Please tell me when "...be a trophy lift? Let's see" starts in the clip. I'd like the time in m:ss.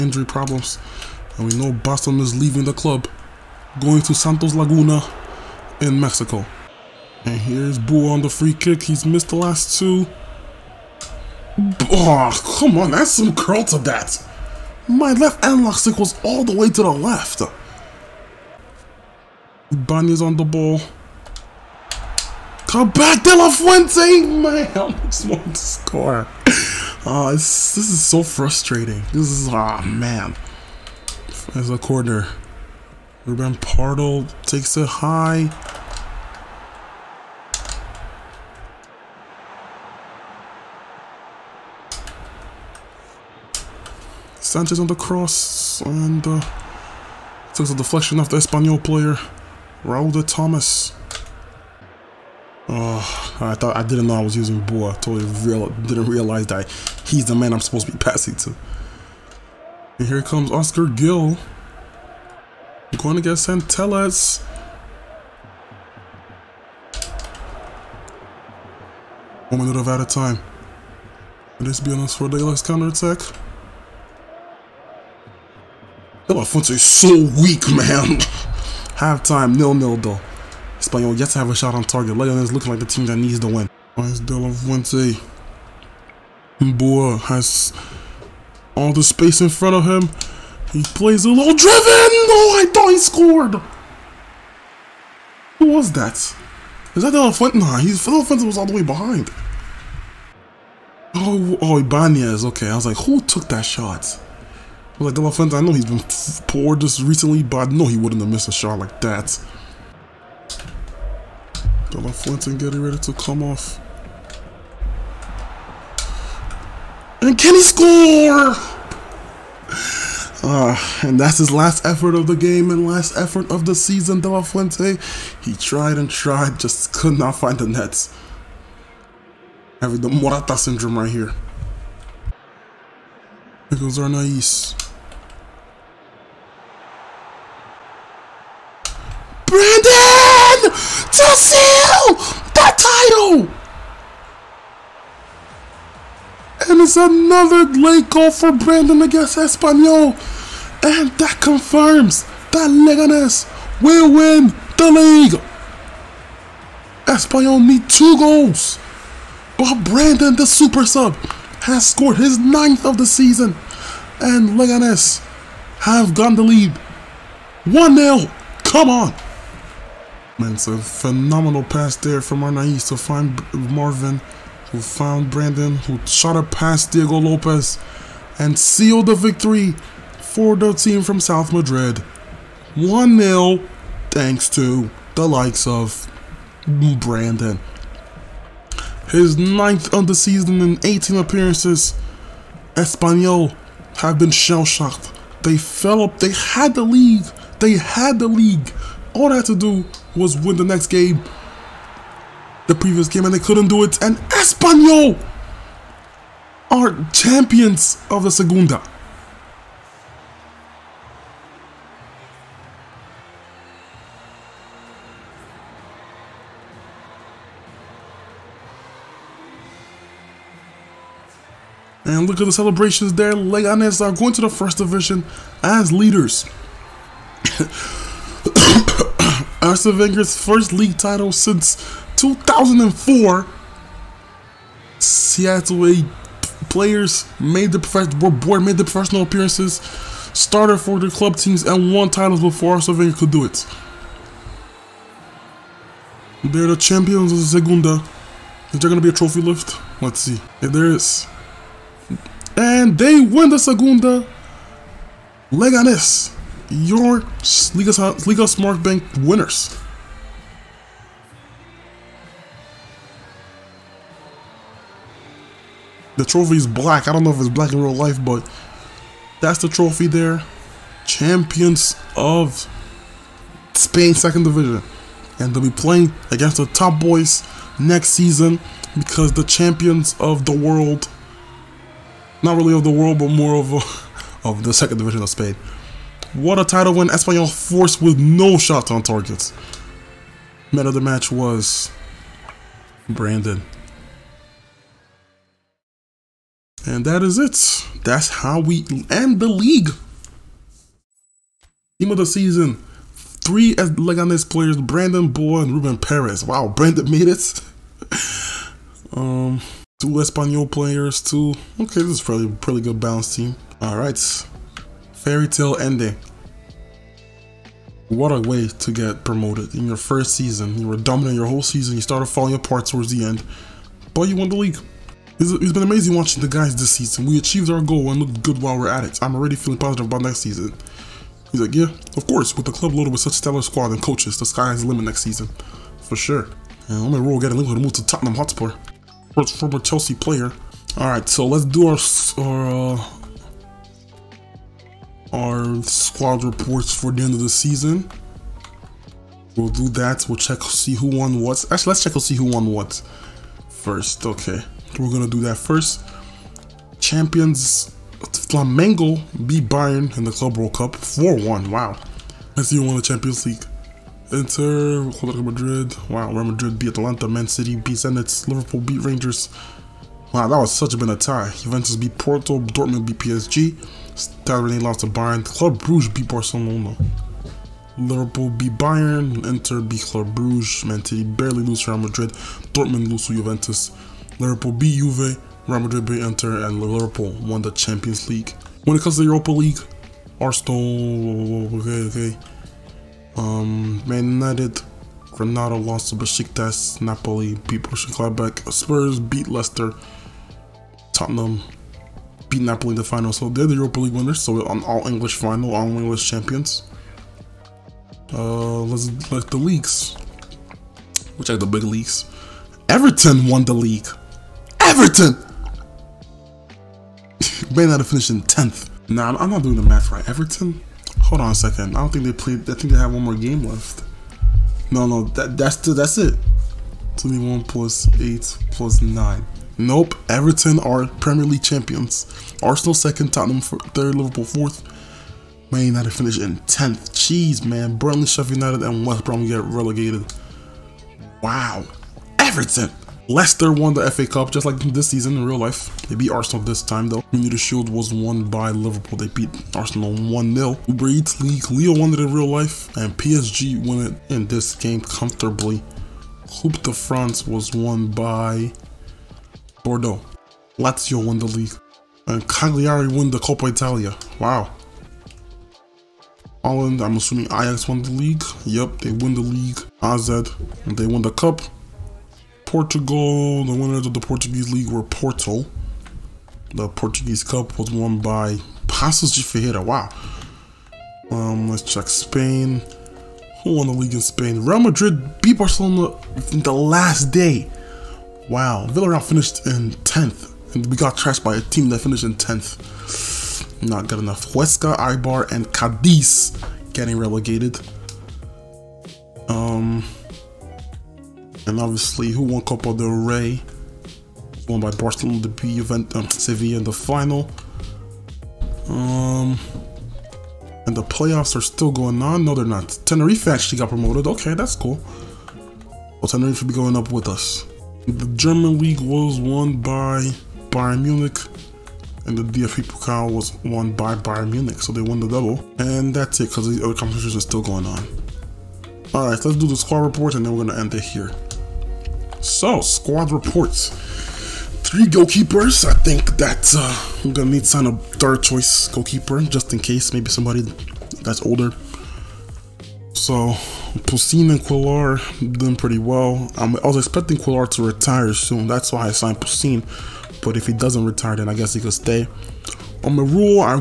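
4:09.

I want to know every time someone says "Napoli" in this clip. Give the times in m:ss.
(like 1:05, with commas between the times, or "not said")
6:37, 6:42.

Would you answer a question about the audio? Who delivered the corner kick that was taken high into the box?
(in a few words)
Ruben Pardo.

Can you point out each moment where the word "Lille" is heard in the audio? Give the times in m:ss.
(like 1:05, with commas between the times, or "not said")
7:31.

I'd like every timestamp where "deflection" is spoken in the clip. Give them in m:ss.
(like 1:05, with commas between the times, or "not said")
0:47.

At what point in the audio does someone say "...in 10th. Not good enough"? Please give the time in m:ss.
8:12.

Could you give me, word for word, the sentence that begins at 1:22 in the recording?
Leon is looking like the team that needs the win.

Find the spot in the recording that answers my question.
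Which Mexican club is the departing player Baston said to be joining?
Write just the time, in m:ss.
0:04.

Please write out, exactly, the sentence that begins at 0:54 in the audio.
Totally real, didn't realize that he's the man I'm supposed to be passing to.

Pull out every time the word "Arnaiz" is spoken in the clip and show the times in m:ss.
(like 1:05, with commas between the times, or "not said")
2:13, 2:52.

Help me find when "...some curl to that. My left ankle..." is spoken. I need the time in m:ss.
0:13.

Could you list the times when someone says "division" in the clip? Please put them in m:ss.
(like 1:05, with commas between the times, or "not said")
3:44, 4:34, 4:44.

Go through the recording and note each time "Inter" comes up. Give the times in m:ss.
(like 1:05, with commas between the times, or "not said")
6:04, 6:19, 6:26.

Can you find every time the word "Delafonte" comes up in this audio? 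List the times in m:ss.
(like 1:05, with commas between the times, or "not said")
1:45, 1:51, 2:04.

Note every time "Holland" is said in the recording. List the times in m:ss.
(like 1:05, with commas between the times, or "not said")
7:46.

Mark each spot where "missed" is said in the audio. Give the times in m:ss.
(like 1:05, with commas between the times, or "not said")
0:09, 1:48.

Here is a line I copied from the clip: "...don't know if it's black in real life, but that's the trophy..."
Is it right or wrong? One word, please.
right.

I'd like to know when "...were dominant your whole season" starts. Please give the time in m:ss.
5:20.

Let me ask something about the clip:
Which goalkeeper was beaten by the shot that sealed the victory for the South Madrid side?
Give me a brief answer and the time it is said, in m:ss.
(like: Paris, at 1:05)
Diego Lopez, at 2:56.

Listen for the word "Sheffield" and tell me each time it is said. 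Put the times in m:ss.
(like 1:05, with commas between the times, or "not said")
7:18.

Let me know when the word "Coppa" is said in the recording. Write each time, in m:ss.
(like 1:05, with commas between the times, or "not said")
7:43.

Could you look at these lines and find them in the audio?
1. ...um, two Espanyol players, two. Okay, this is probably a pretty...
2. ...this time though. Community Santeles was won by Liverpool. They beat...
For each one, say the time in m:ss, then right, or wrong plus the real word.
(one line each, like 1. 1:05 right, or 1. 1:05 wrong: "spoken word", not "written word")
1. 5:09 right
2. 7:26 wrong: "Shield", not "Santeles".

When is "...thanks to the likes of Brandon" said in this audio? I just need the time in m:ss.
3:04.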